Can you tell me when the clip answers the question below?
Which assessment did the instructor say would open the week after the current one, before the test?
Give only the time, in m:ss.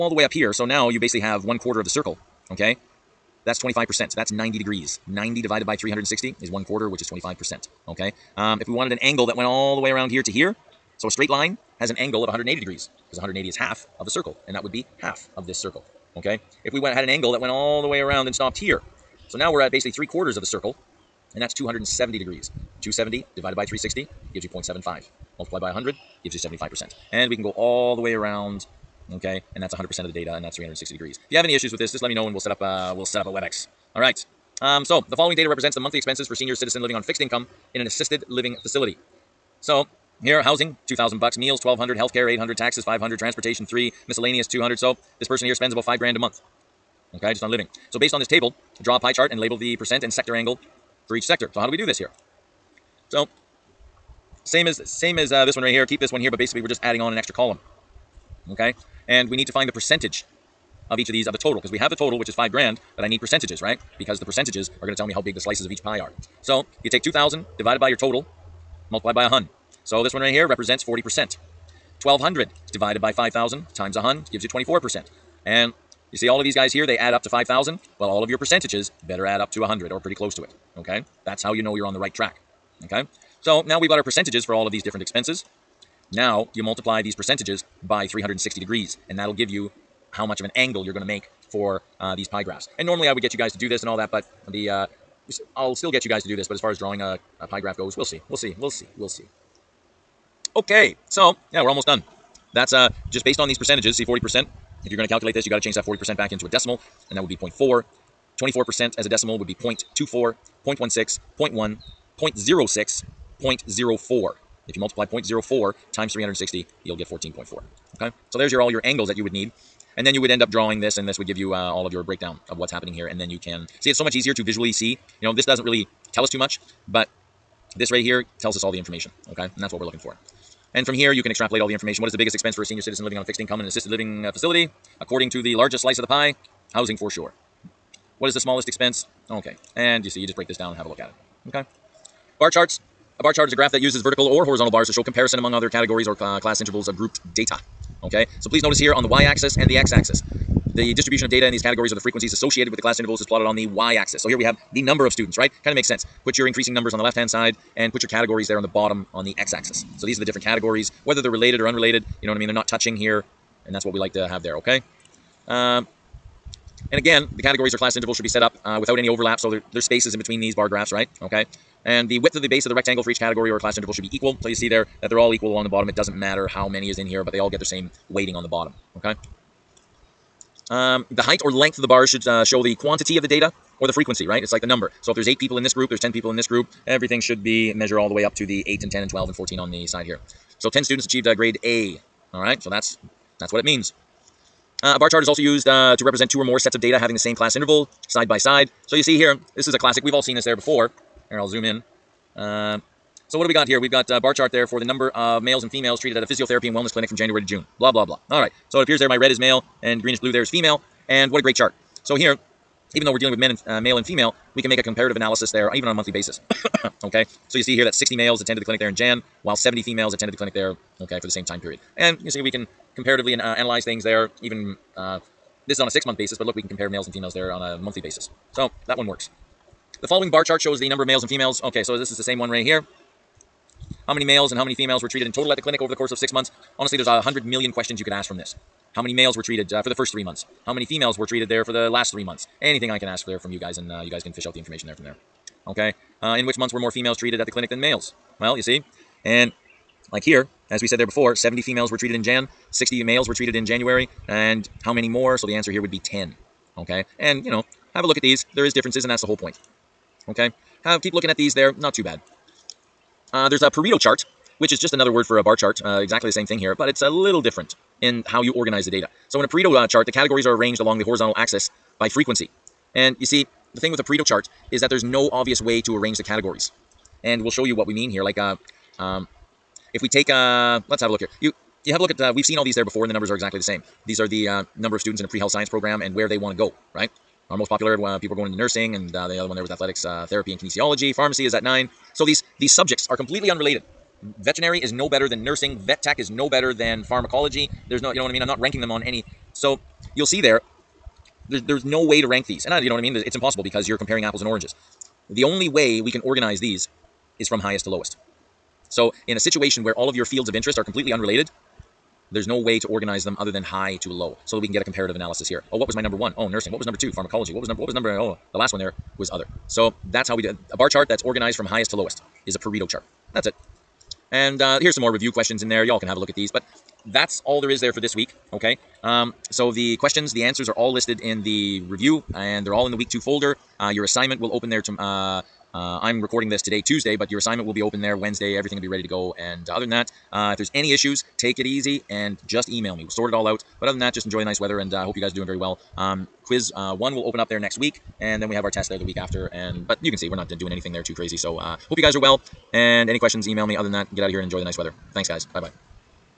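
5:46.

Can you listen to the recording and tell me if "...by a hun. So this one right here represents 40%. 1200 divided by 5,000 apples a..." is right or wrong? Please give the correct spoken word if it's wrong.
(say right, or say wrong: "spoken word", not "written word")
wrong: "times", not "apples".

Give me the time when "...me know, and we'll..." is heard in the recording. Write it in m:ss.
0:32.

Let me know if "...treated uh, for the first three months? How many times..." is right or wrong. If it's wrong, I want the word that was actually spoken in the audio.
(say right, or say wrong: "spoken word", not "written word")
wrong: "females", not "times".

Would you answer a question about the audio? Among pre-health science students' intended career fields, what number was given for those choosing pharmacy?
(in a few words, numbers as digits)
9.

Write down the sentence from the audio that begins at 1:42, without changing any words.
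That's uh, just based on these percentages.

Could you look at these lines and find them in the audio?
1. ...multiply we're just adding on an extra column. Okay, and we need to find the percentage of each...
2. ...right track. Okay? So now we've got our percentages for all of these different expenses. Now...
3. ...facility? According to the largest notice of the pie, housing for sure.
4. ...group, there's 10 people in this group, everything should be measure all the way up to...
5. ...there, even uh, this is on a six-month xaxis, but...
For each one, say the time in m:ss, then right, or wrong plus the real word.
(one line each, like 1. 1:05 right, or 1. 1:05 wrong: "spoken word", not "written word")
1. 0:56 wrong: "basically", not "multiply"
2. 1:21 right
3. 2:14 wrong: "slice", not "notice"
4. 3:05 right
5. 3:44 wrong: "basis", not "xaxis".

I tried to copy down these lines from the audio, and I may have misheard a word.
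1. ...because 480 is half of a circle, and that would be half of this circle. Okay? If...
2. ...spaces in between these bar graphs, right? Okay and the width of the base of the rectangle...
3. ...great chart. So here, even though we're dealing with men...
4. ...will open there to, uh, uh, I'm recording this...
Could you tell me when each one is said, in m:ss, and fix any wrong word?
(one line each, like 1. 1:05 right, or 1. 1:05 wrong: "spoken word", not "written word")
1. 0:13 wrong: "180", not "480"
2. 2:49 right
3. 3:31 right
4. 5:34 right.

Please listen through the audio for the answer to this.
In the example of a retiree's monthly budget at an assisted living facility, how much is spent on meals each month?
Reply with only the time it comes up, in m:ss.
0:41.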